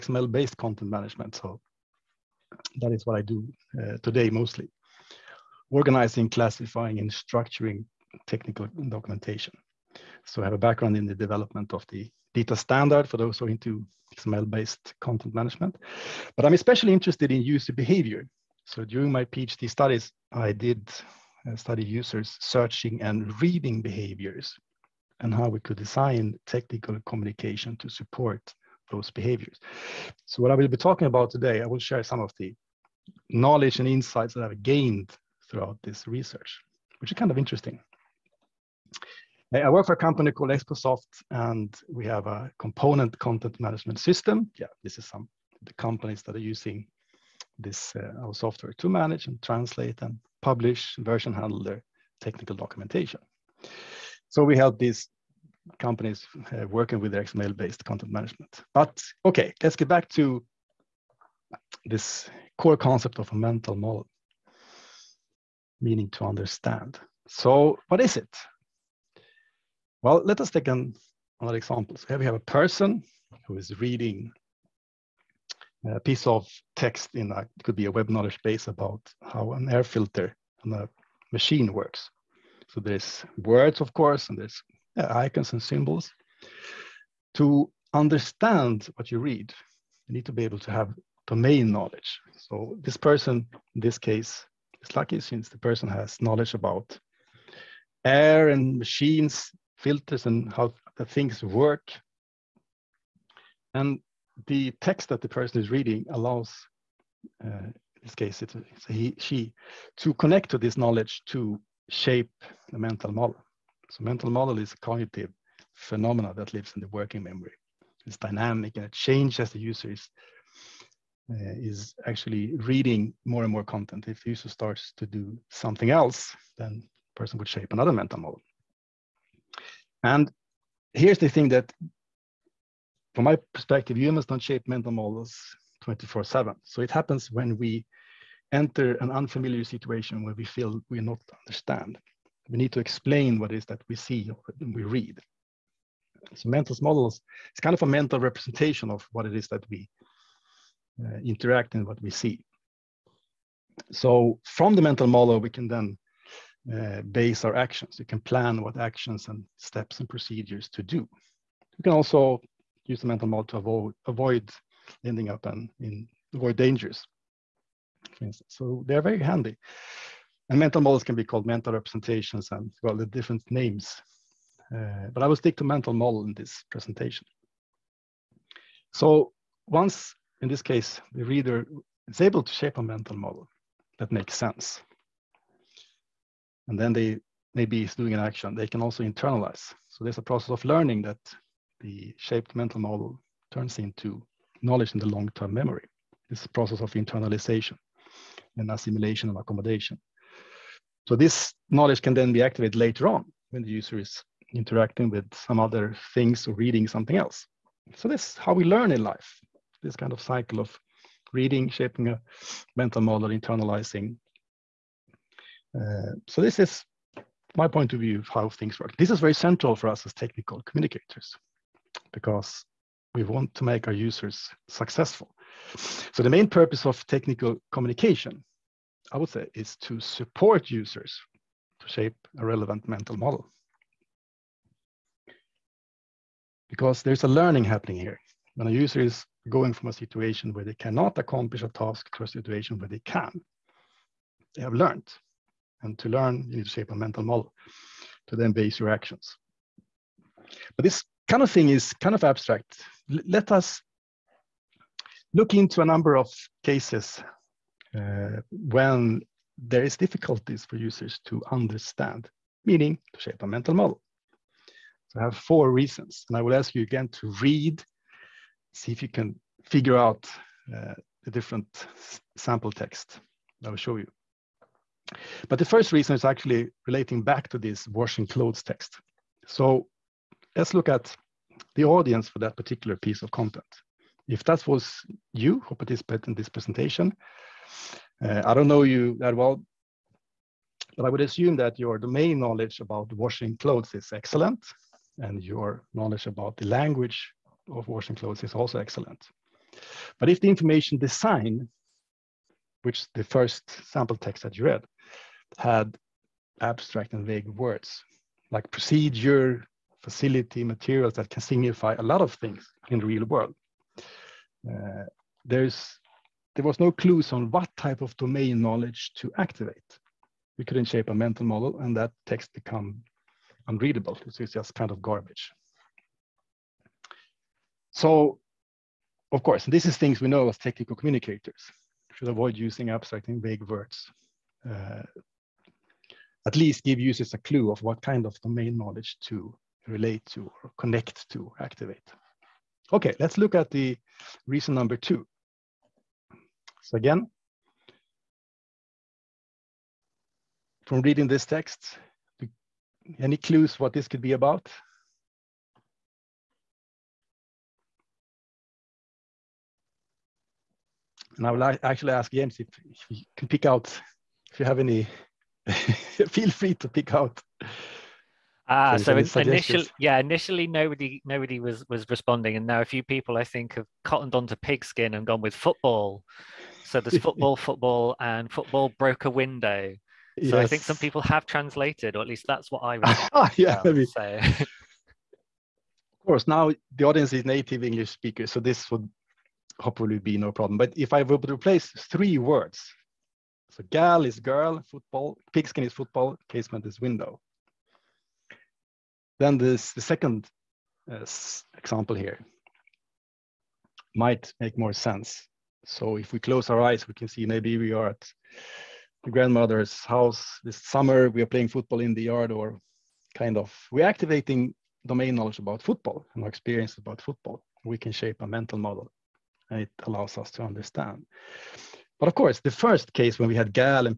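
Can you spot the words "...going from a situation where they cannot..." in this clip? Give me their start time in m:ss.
3:59.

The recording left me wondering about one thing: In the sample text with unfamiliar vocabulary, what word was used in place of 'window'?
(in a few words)
casement.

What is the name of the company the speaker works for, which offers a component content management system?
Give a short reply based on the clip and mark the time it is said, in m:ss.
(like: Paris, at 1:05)
Excosoft, at 0:40.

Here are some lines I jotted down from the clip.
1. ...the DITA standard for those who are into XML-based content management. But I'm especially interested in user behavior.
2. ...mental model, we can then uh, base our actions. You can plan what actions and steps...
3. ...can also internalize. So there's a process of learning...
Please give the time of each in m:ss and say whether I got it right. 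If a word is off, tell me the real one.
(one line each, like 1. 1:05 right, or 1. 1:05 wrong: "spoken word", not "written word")
1. 0:11 right
2. 2:34 right
3. 3:08 right.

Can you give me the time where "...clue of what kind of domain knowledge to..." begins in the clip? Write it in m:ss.
5:37.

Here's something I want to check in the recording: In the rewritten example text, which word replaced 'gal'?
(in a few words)
girl.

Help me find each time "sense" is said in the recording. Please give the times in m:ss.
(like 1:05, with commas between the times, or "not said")
3:04, 6:44.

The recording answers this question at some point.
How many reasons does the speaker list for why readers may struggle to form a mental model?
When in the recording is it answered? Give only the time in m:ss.
4:25.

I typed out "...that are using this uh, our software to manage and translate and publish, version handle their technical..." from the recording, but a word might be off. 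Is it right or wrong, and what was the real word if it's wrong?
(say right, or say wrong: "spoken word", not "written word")
right.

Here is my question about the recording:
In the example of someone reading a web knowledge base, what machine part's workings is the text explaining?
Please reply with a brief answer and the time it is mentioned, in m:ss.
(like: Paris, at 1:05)
air filter, at 1:19.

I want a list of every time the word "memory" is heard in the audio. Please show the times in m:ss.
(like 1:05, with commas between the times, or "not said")
1:57, 3:15.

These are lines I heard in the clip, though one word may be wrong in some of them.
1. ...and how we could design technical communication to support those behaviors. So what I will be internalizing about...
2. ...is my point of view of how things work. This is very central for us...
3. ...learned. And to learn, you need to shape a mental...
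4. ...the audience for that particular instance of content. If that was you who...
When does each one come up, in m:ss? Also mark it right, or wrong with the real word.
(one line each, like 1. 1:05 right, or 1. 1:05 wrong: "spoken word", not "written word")
1. 0:25 wrong: "talking", not "internalizing"
2. 3:36 right
3. 4:04 right
4. 4:41 wrong: "piece", not "instance".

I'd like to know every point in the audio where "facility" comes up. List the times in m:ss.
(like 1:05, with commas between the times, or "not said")
5:10.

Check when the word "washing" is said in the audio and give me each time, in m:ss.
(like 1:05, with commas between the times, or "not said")
4:37, 4:53, 4:57.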